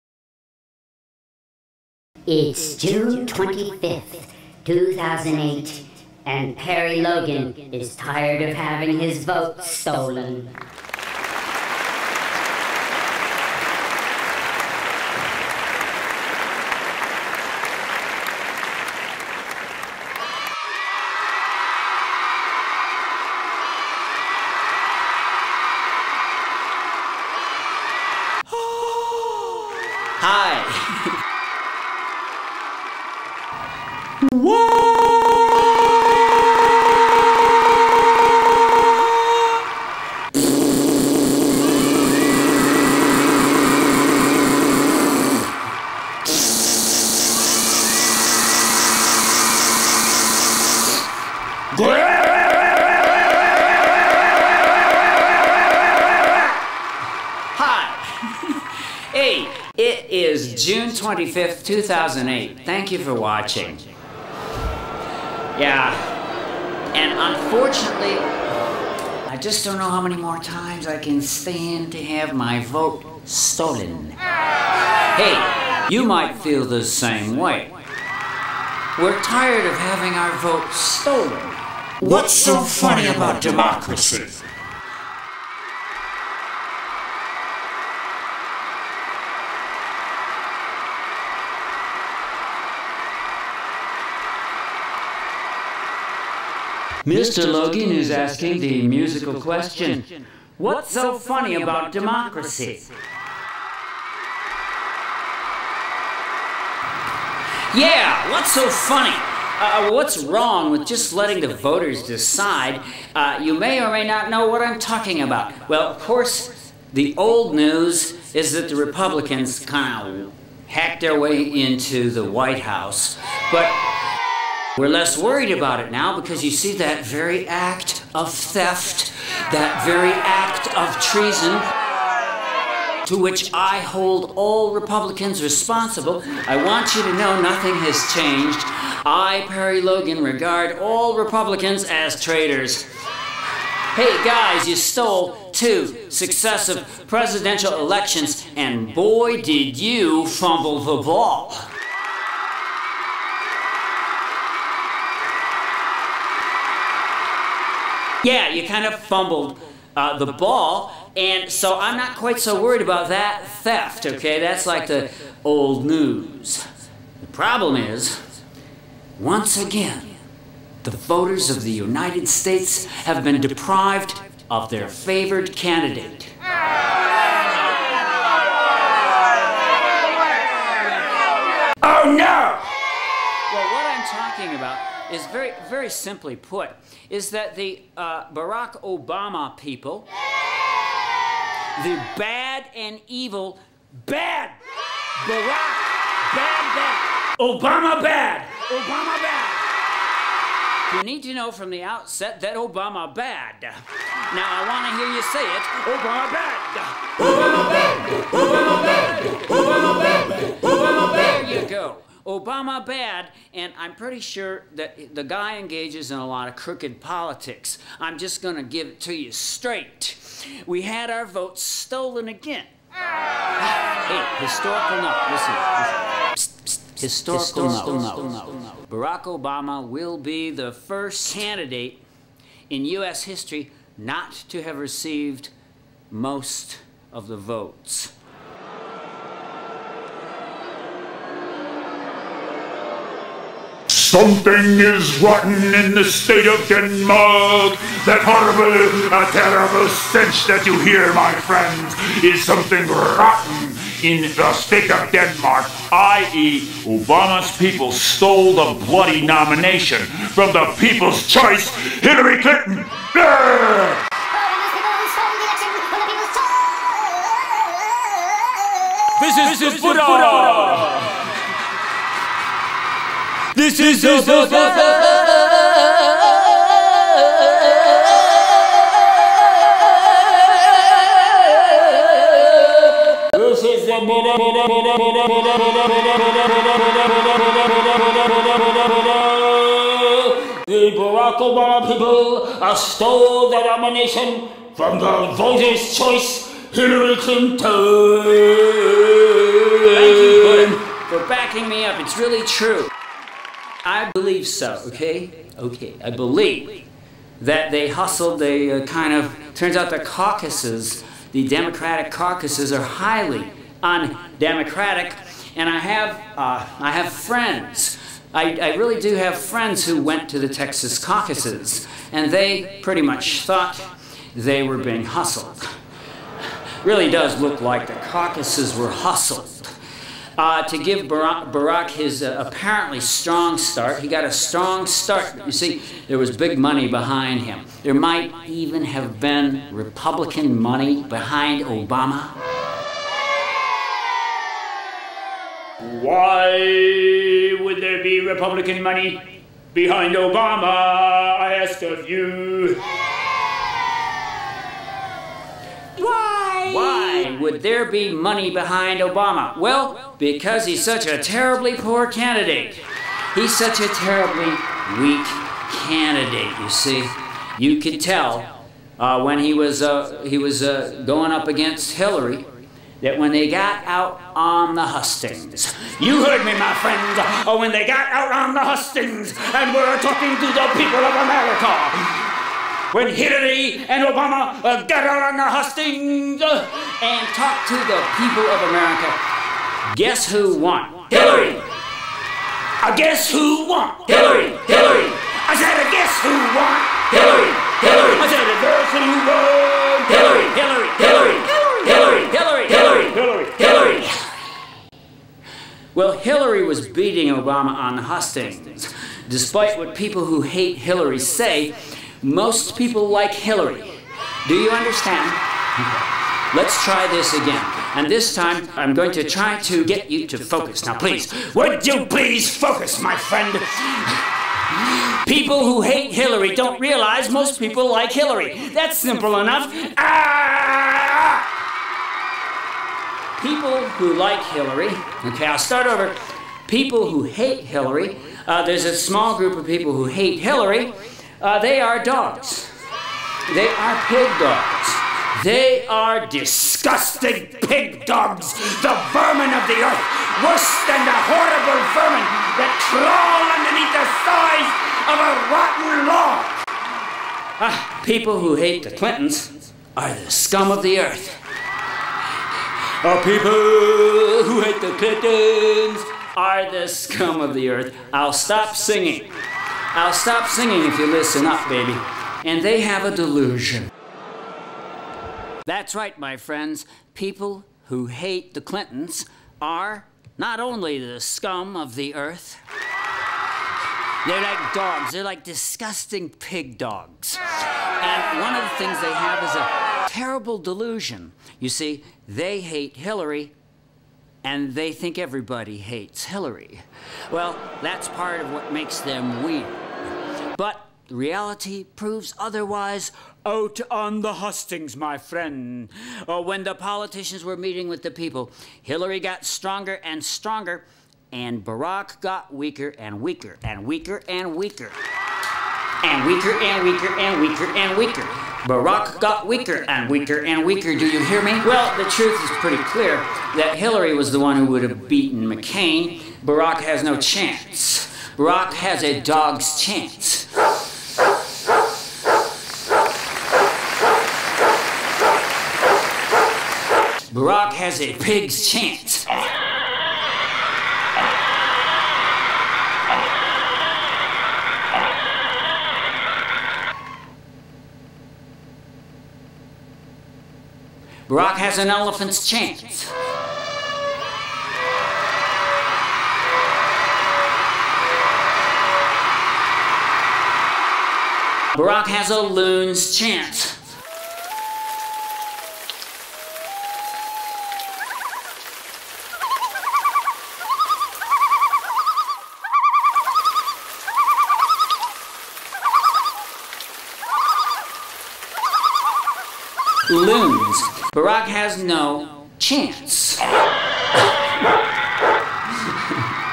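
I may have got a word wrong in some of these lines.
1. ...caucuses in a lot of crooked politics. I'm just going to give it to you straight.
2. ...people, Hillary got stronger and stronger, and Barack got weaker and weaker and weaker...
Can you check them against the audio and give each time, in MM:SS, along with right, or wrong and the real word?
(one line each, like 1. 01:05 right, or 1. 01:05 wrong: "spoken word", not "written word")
1. 03:35 wrong: "engages", not "caucuses"
2. 08:28 right.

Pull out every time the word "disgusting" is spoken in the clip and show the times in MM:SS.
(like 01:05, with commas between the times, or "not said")
07:26, 08:05.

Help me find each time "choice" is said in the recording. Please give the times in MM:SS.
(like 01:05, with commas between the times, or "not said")
04:21, 04:55.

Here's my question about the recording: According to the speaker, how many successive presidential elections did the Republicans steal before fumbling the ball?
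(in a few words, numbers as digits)
2.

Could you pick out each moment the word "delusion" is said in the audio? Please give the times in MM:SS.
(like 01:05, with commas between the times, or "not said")
07:53, 08:10.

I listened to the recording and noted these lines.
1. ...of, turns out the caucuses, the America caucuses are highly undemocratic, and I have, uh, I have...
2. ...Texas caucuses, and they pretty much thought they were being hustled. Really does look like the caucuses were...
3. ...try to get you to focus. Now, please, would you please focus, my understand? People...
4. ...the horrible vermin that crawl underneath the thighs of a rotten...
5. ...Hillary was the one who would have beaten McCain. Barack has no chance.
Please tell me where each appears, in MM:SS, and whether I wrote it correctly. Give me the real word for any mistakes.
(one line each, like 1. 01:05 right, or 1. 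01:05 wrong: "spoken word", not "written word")
1. 05:09 wrong: "Democratic", not "America"
2. 05:20 right
3. 06:59 wrong: "friend", not "understand"
4. 07:31 right
5. 08:43 right.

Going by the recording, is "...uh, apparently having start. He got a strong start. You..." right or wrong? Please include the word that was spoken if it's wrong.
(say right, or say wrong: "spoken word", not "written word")
wrong: "strong", not "having".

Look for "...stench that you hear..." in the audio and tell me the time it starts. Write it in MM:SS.
04:09.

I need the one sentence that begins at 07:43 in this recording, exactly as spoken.
Our oh, people who hate the Clintons are the scum of the earth.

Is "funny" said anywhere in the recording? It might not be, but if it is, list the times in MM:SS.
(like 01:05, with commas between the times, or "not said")
01:22, 01:41, 01:48.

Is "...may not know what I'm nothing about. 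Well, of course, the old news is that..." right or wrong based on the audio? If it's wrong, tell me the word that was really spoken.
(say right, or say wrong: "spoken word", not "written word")
wrong: "talking", not "nothing".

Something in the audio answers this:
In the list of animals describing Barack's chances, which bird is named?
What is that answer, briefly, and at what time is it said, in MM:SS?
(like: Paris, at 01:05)
Loon, at 09:22.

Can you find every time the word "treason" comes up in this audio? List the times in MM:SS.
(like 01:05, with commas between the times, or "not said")
02:11.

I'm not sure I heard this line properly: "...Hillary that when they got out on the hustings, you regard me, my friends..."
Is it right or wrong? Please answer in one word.
wrong.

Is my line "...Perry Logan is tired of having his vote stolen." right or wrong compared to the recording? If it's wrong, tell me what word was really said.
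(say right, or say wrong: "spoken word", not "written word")
right.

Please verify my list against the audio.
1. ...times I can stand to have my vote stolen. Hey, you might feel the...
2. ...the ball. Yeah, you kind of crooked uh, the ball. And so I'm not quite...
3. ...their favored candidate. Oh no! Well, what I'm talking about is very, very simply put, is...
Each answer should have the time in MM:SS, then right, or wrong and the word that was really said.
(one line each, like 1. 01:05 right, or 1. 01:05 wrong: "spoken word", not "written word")
1. 01:10 right
2. 02:30 wrong: "fumbled", not "crooked"
3. 02:54 right.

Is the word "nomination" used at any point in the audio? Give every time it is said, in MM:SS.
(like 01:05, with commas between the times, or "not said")
04:19, 04:53.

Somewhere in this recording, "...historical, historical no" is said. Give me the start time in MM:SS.
03:47.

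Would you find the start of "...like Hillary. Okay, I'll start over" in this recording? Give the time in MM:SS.
07:14.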